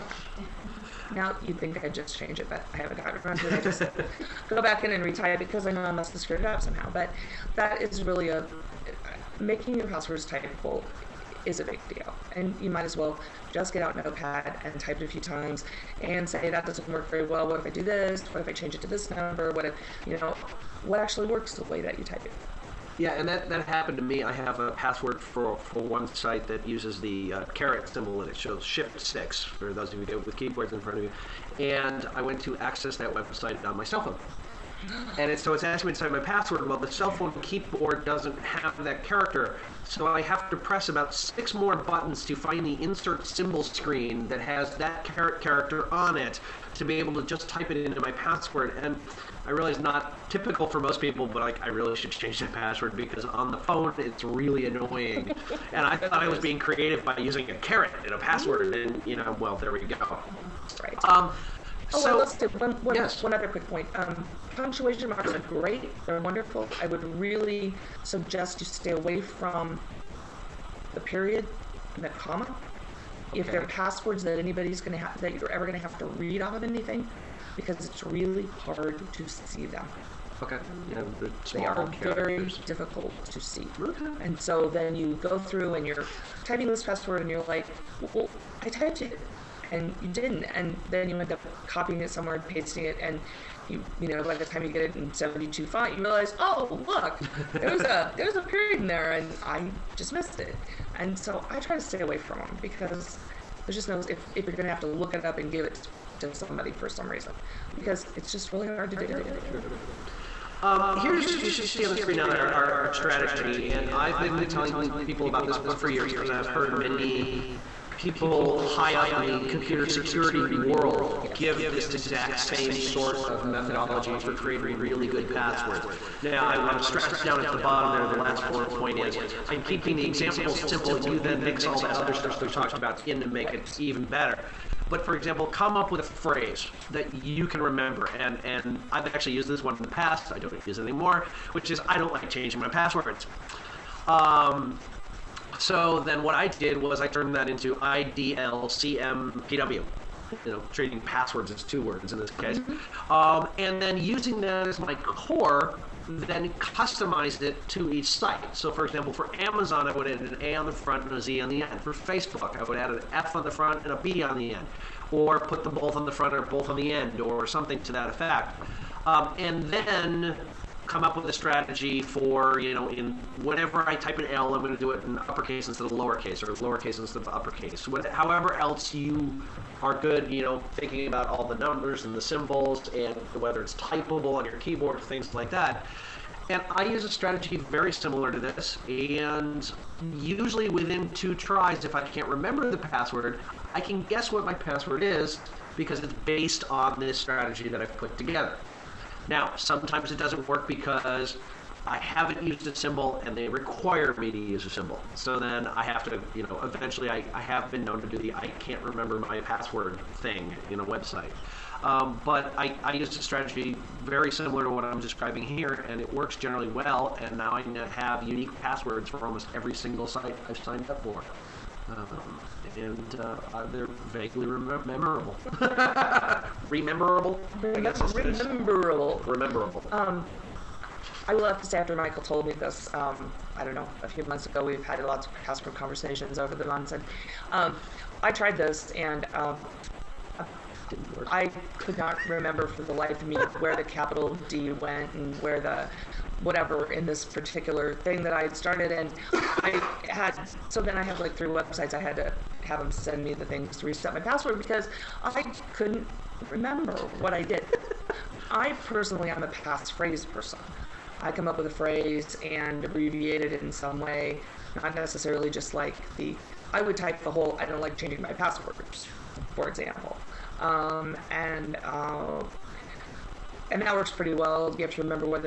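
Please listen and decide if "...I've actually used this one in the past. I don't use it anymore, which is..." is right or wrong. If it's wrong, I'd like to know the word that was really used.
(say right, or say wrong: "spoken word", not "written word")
right.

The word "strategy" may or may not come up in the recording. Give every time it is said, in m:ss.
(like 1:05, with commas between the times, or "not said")
1:52, 2:51, 3:07, 3:17, 3:33.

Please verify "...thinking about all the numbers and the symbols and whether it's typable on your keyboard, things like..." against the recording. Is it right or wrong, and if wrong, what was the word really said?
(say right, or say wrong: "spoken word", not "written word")
right.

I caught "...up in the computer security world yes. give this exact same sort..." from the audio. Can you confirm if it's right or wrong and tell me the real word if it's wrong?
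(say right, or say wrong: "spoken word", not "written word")
right.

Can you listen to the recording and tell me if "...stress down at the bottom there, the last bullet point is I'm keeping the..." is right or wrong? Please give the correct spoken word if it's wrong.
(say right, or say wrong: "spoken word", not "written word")
right.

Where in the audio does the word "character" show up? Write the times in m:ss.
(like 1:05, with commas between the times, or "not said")
0:39, 0:45, 1:21.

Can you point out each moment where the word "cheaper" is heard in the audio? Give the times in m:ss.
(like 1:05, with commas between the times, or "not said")
not said.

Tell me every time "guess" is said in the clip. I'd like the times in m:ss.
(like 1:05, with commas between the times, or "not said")
3:14, 3:47.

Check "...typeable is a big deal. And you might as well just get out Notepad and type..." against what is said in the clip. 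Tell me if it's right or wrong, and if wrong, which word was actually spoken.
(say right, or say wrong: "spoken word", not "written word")
right.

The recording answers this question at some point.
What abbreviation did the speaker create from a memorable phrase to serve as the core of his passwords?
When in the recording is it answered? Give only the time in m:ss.
2:27.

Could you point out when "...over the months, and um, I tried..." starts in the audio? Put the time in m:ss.
3:56.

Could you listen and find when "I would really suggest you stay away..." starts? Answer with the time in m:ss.
1:06.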